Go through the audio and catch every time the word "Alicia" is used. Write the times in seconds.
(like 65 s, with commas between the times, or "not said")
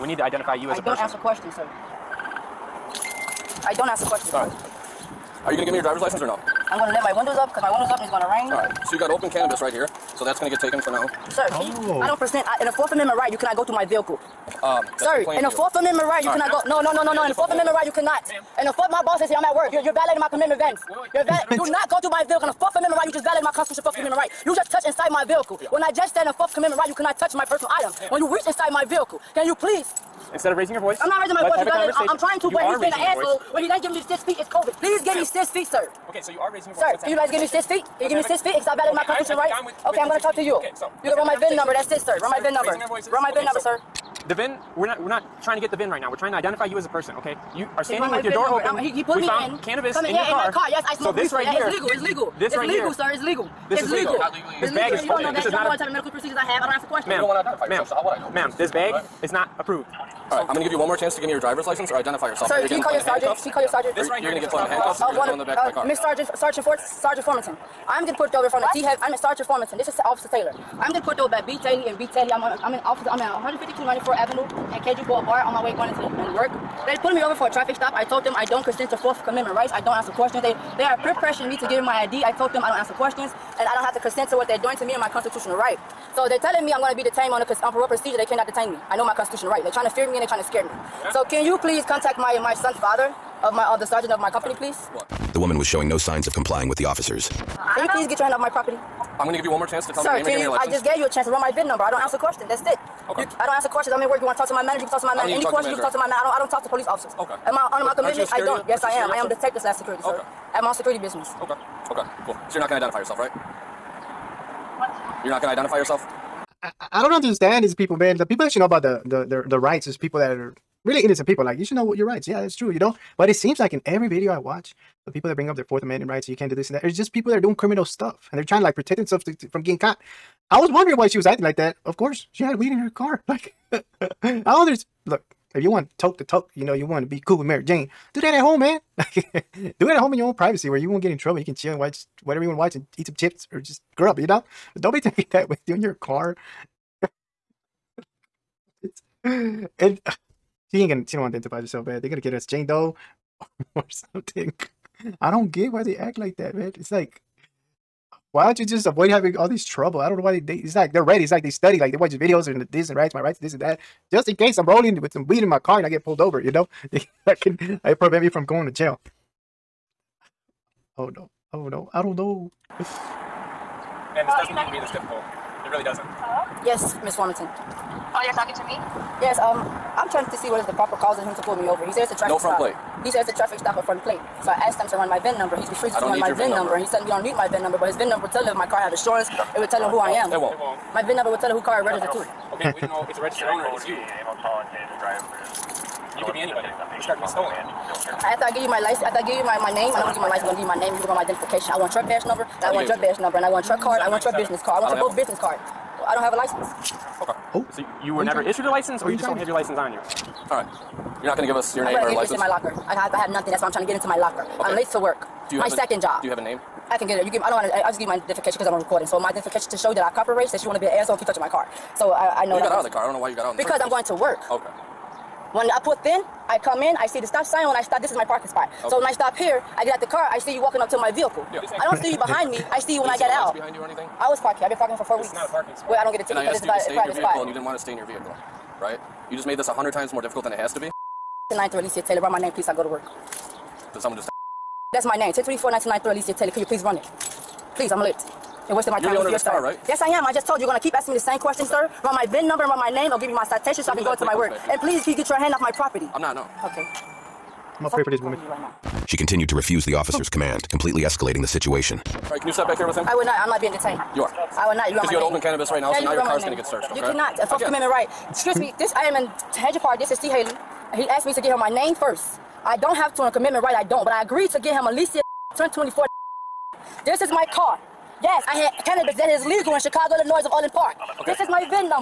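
241 s, 246 s, 274 s.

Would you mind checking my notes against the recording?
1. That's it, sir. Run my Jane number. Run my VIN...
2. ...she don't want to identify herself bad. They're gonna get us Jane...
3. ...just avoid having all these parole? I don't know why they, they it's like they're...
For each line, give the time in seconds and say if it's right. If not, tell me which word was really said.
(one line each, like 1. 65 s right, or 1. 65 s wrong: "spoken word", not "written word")
1. 41 s wrong: "VIN", not "Jane"
2. 151 s right
3. 158 s wrong: "trouble", not "parole".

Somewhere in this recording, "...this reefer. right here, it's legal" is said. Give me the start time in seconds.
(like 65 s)
51 s.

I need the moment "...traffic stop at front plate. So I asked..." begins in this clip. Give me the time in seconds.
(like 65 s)
183 s.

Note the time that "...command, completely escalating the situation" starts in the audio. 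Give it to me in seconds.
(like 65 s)
260 s.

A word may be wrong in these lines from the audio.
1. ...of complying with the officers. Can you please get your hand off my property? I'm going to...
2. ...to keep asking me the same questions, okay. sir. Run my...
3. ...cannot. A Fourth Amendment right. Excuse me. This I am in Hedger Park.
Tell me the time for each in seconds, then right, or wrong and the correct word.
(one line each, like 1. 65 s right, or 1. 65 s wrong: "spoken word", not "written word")
1. 96 s right
2. 250 s right
3. 267 s right.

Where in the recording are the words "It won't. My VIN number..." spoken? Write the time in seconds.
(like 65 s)
190 s.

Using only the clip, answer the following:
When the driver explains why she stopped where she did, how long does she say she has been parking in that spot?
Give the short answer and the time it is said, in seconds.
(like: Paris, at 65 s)
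4 weeks, at 235 s.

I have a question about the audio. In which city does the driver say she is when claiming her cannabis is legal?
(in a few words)
Orland Park.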